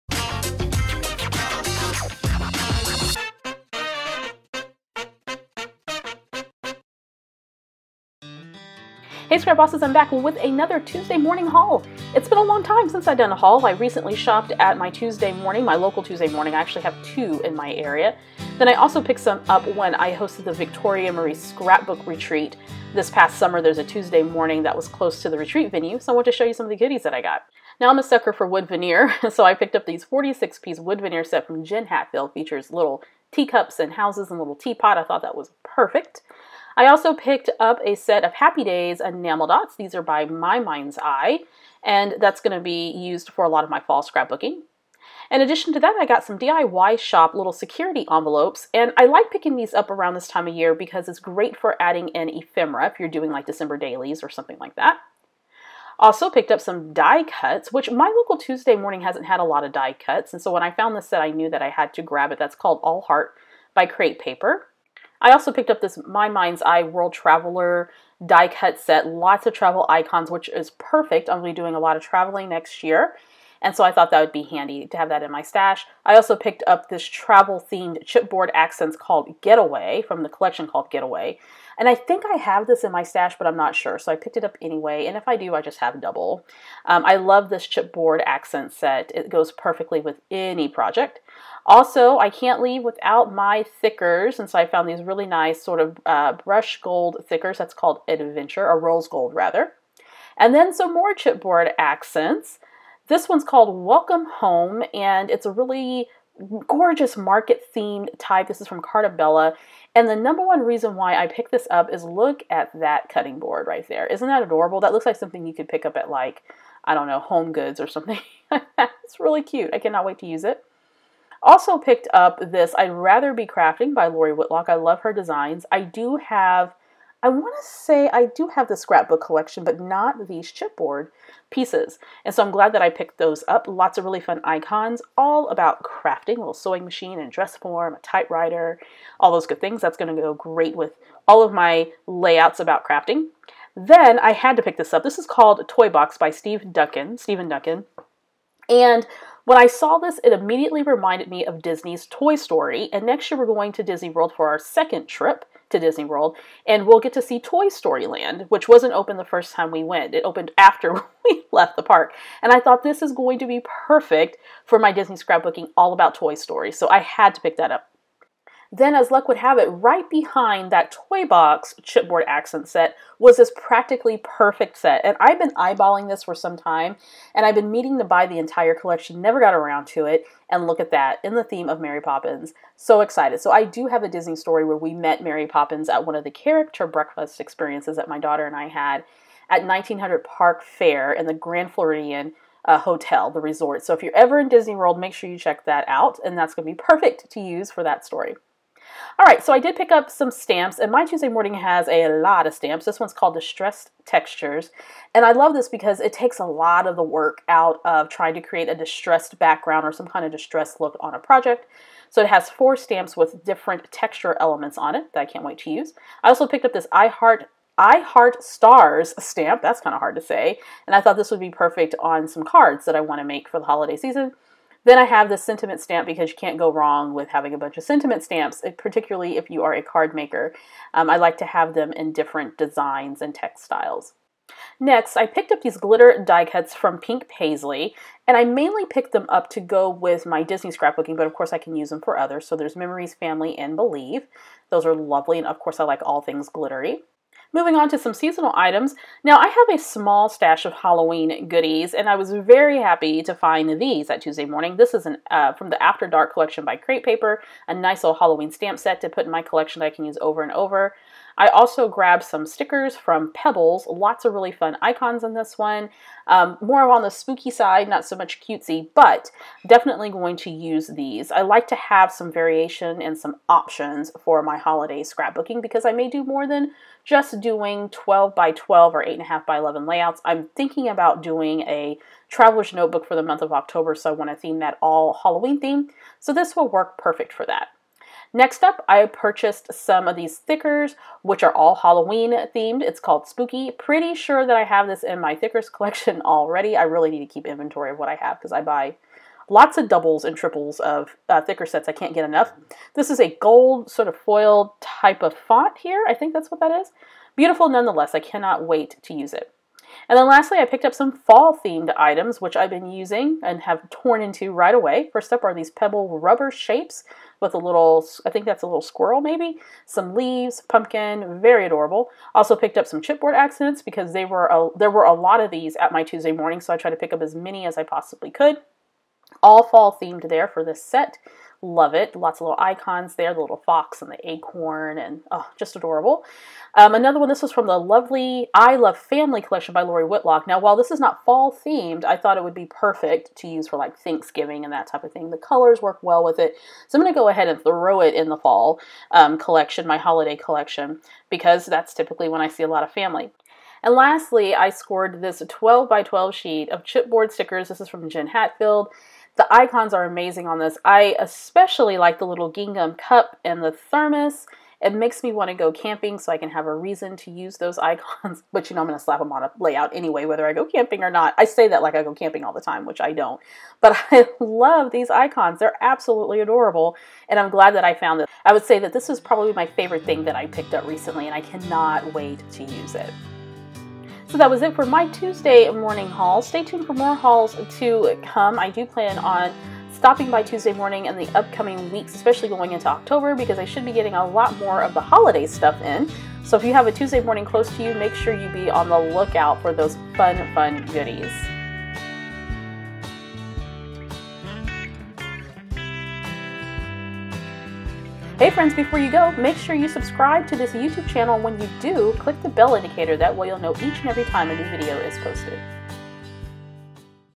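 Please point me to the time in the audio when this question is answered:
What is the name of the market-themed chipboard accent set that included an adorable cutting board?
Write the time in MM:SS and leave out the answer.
01:43.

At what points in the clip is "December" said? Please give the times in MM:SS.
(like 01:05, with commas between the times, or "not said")
00:53.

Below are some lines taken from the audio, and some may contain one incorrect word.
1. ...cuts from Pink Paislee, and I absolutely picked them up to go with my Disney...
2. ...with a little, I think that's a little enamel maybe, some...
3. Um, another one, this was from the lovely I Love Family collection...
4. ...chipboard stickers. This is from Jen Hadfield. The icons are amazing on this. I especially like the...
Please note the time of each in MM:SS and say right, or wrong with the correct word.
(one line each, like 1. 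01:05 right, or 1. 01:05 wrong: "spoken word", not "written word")
1. 03:56 wrong: "mainly", not "absolutely"
2. 05:17 wrong: "squirrel", not "enamel"
3. 05:36 right
4. 05:56 right.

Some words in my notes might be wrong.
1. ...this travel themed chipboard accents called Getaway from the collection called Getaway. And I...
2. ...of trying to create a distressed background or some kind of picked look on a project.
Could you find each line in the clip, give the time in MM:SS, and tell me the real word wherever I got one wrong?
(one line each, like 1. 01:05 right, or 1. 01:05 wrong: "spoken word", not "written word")
1. 01:16 right
2. 03:27 wrong: "distressed", not "picked".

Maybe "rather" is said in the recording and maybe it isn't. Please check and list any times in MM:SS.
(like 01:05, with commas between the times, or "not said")
01:39, 02:02.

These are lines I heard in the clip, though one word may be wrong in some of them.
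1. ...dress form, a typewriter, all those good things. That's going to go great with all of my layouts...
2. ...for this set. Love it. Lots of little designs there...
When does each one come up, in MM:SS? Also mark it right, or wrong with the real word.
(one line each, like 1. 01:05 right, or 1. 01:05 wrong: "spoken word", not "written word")
1. 02:17 right
2. 05:30 wrong: "icons", not "designs".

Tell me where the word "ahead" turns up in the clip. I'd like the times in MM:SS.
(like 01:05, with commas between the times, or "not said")
05:47.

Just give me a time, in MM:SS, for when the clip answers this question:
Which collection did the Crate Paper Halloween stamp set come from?
04:15.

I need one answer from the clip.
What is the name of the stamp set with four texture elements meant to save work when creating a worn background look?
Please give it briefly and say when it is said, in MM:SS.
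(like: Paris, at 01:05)
Distressed Textures, at 03:23.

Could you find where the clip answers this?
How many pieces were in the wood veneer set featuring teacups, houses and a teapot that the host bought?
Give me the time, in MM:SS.
00:30.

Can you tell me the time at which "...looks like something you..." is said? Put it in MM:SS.
01:54.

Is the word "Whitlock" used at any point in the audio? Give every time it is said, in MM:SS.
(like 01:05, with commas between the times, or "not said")
02:04, 05:40.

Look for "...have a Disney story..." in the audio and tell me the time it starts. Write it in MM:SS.
03:03.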